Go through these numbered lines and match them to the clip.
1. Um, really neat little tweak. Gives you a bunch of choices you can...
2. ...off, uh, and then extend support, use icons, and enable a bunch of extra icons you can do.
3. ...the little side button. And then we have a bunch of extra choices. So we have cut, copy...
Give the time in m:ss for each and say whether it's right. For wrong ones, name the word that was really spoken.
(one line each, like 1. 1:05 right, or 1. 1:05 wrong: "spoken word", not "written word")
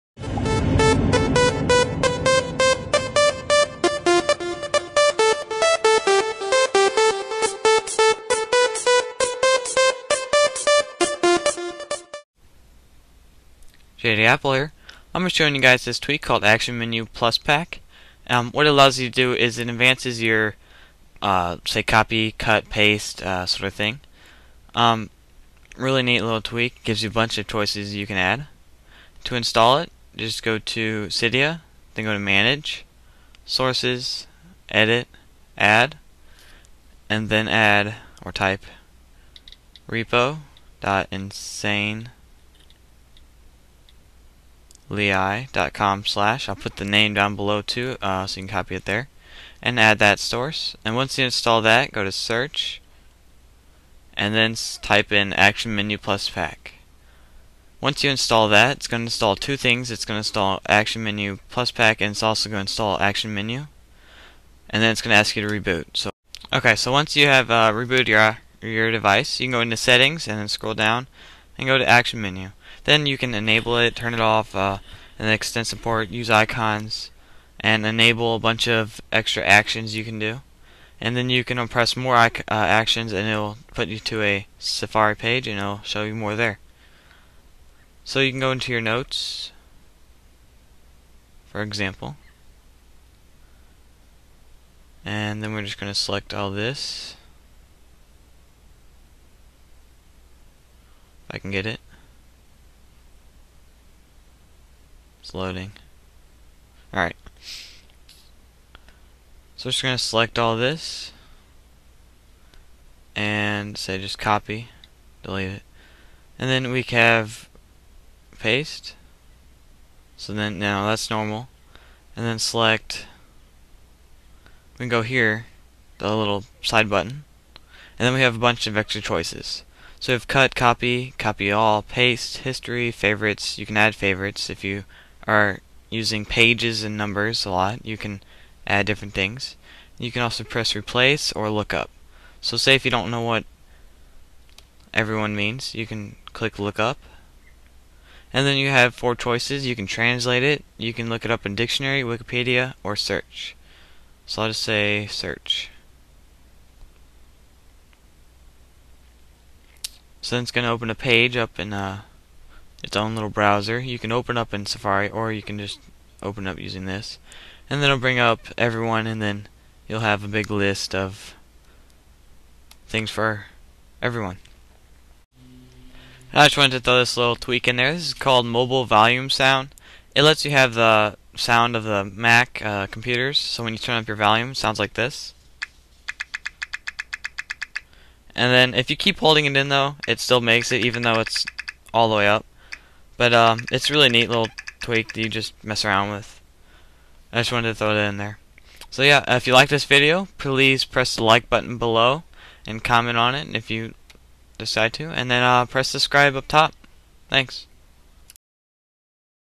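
1. 0:24 right
2. 1:14 wrong: "actions", not "icons"
3. 2:05 right.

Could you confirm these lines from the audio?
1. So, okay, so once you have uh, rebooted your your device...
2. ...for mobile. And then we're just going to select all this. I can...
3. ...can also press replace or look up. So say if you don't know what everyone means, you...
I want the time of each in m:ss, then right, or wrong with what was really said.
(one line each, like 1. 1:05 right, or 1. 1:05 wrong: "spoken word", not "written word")
1. 1:05 right
2. 1:31 wrong: "example", not "mobile"
3. 2:20 right.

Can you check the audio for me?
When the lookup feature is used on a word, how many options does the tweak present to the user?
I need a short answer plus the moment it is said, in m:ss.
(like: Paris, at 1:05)
4, at 2:28.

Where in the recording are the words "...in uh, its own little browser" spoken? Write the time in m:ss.
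2:41.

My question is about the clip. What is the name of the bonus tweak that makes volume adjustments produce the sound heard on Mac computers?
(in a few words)
Mobile Volume Sound.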